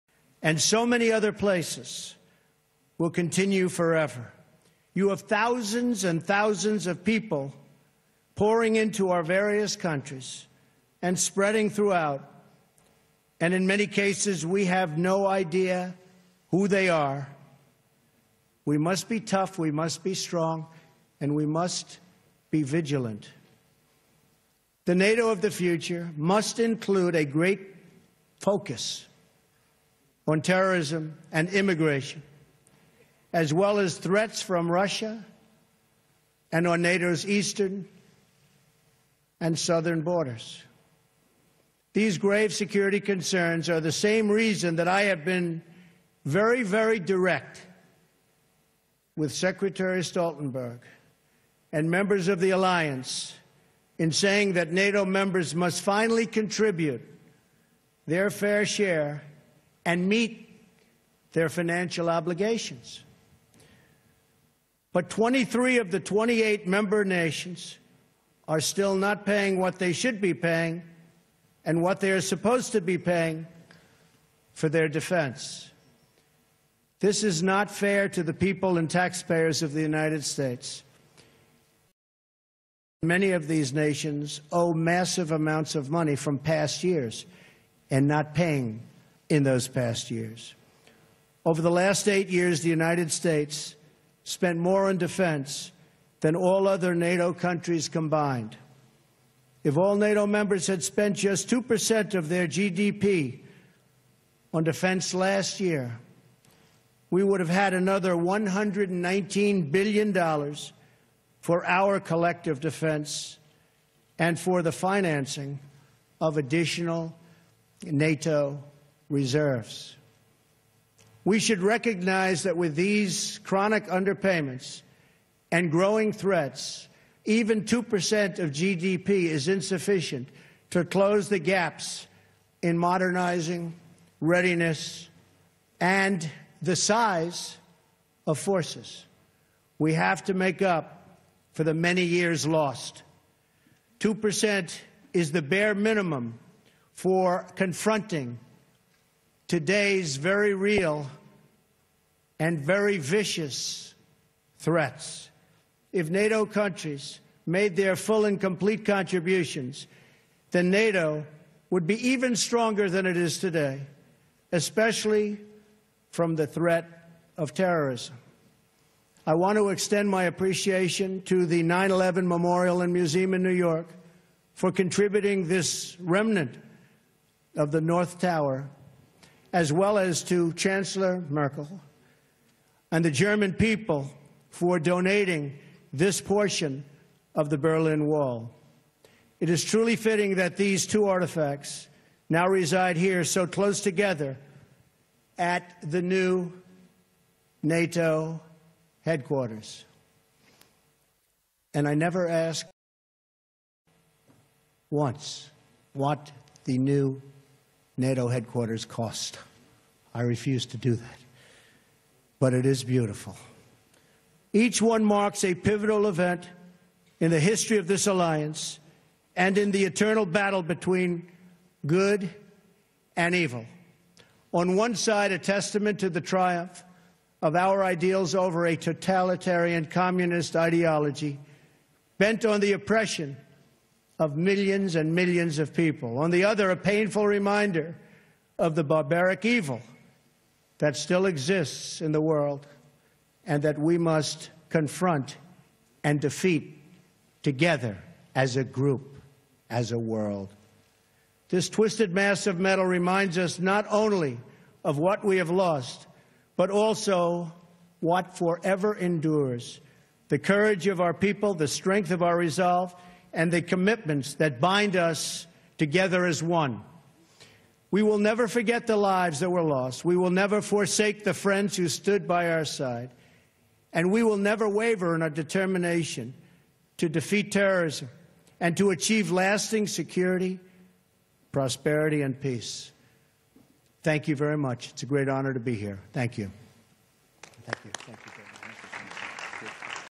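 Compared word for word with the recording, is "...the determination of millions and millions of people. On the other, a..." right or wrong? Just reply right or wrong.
wrong.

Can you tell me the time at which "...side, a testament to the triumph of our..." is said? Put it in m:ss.
3:44.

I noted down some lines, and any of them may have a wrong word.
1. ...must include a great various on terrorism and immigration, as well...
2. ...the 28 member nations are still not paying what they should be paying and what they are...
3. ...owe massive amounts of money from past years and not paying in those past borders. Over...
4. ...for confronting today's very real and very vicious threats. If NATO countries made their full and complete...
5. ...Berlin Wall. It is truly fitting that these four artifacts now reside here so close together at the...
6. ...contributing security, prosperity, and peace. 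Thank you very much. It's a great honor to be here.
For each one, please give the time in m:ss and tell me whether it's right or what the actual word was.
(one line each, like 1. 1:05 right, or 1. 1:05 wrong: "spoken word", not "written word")
1. 0:26 wrong: "focus", not "various"
2. 1:05 right
3. 1:24 wrong: "years", not "borders"
4. 2:26 right
5. 3:07 wrong: "two", not "four"
6. 4:39 wrong: "lasting", not "contributing".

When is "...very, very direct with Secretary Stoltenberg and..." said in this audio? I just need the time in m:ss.
0:46.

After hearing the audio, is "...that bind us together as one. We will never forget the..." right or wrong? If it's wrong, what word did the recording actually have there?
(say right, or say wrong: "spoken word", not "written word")
right.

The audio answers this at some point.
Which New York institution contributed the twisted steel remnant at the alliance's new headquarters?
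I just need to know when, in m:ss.
2:51.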